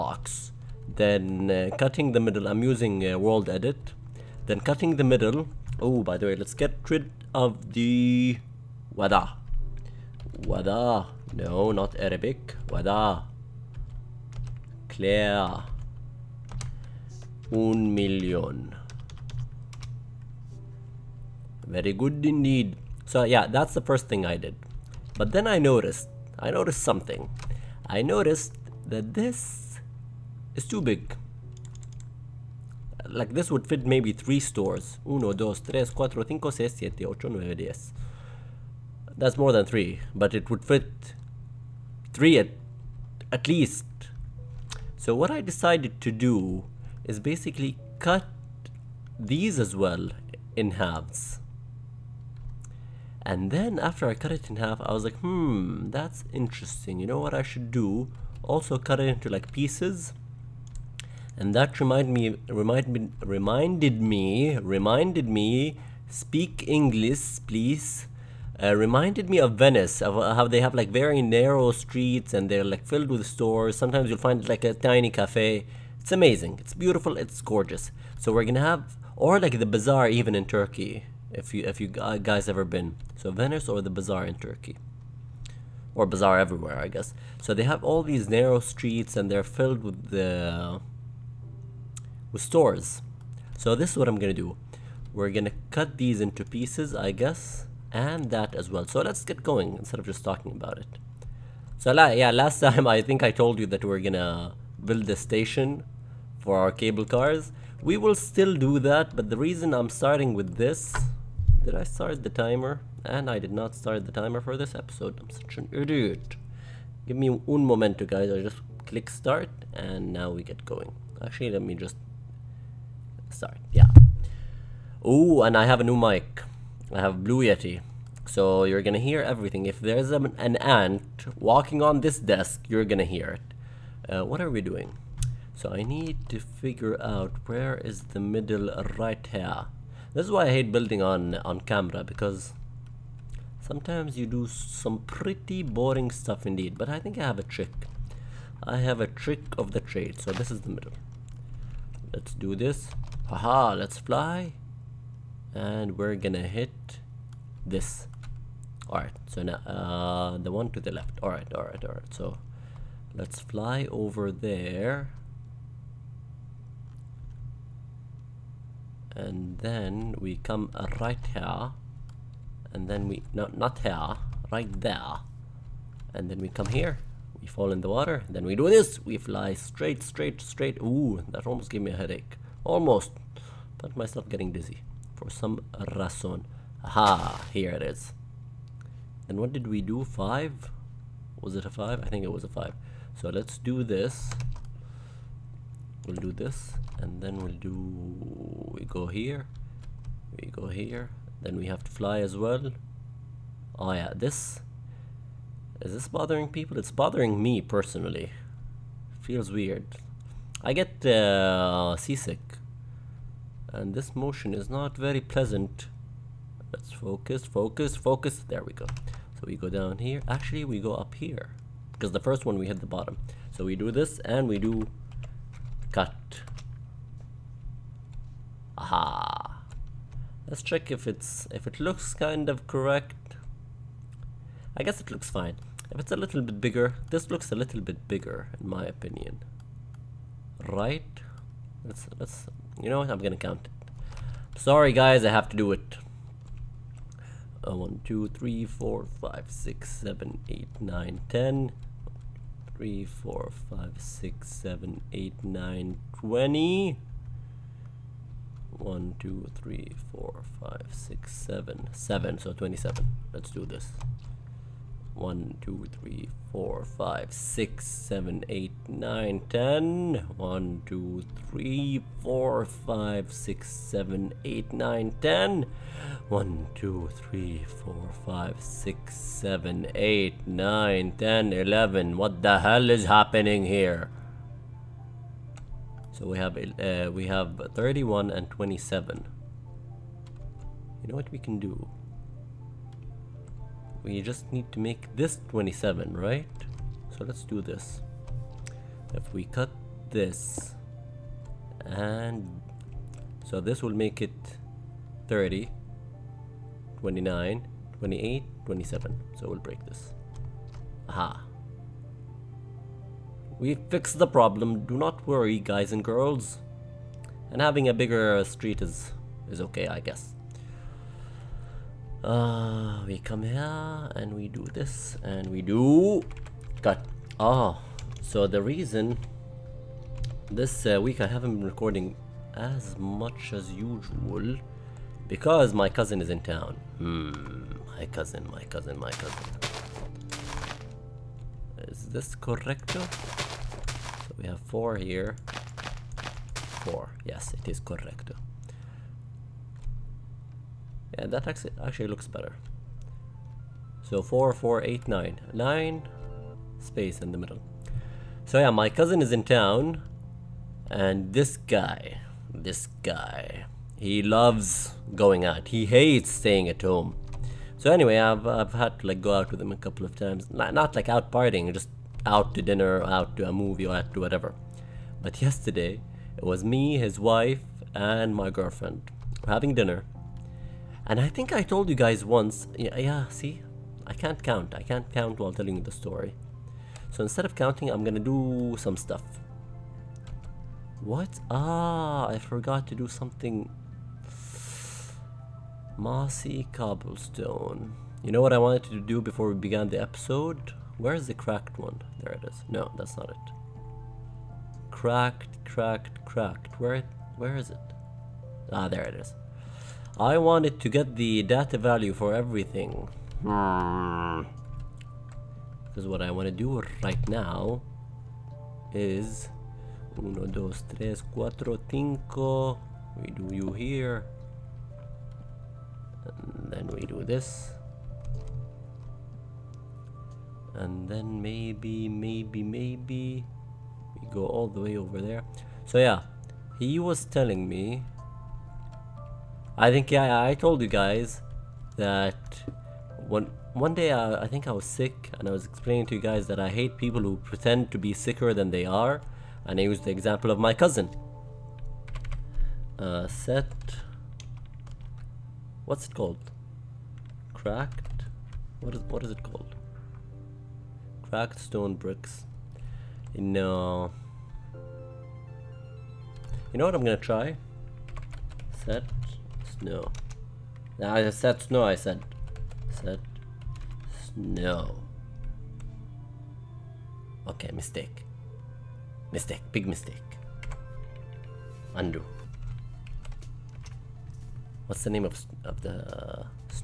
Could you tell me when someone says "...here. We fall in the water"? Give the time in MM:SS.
02:56.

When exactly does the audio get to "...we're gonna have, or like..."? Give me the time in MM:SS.
01:18.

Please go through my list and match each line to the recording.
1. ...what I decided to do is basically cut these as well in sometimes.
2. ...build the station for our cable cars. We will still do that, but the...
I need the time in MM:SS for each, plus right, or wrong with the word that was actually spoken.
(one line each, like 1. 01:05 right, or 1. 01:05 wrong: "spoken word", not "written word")
1. 00:45 wrong: "halves", not "sometimes"
2. 01:44 right.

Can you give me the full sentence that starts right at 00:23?
So yeah, that's the first thing I did.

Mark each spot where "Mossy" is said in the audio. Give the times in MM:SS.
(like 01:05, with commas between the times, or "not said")
06:35.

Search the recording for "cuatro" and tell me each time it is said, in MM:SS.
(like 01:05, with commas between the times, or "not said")
00:35, 07:01.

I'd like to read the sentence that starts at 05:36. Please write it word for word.
Hmm, my cousin, my cousin, my cousin.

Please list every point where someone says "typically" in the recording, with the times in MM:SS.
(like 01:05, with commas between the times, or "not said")
not said.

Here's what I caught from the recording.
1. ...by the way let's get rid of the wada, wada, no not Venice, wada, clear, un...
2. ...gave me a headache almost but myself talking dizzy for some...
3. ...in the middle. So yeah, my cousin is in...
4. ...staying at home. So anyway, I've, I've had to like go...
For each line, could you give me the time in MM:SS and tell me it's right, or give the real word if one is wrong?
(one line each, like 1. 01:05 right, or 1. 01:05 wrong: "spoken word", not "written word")
1. 00:06 wrong: "Arabic", not "Venice"
2. 03:01 wrong: "getting", not "talking"
3. 05:57 right
4. 06:06 right.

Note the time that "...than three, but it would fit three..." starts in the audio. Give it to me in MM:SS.
00:39.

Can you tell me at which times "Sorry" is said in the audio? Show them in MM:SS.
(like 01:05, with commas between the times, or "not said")
02:03, 04:04.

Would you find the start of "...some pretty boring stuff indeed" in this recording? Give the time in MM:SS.
02:24.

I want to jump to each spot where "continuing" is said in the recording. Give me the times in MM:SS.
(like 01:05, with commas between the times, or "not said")
not said.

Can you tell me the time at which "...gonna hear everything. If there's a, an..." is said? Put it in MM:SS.
02:08.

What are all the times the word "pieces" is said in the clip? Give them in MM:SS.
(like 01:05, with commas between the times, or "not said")
00:59, 01:36.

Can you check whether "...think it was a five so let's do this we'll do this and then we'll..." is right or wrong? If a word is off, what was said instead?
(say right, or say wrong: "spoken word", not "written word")
right.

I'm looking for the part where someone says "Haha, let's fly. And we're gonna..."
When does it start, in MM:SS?
02:33.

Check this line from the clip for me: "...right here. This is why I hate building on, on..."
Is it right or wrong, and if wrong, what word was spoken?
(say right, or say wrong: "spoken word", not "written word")
right.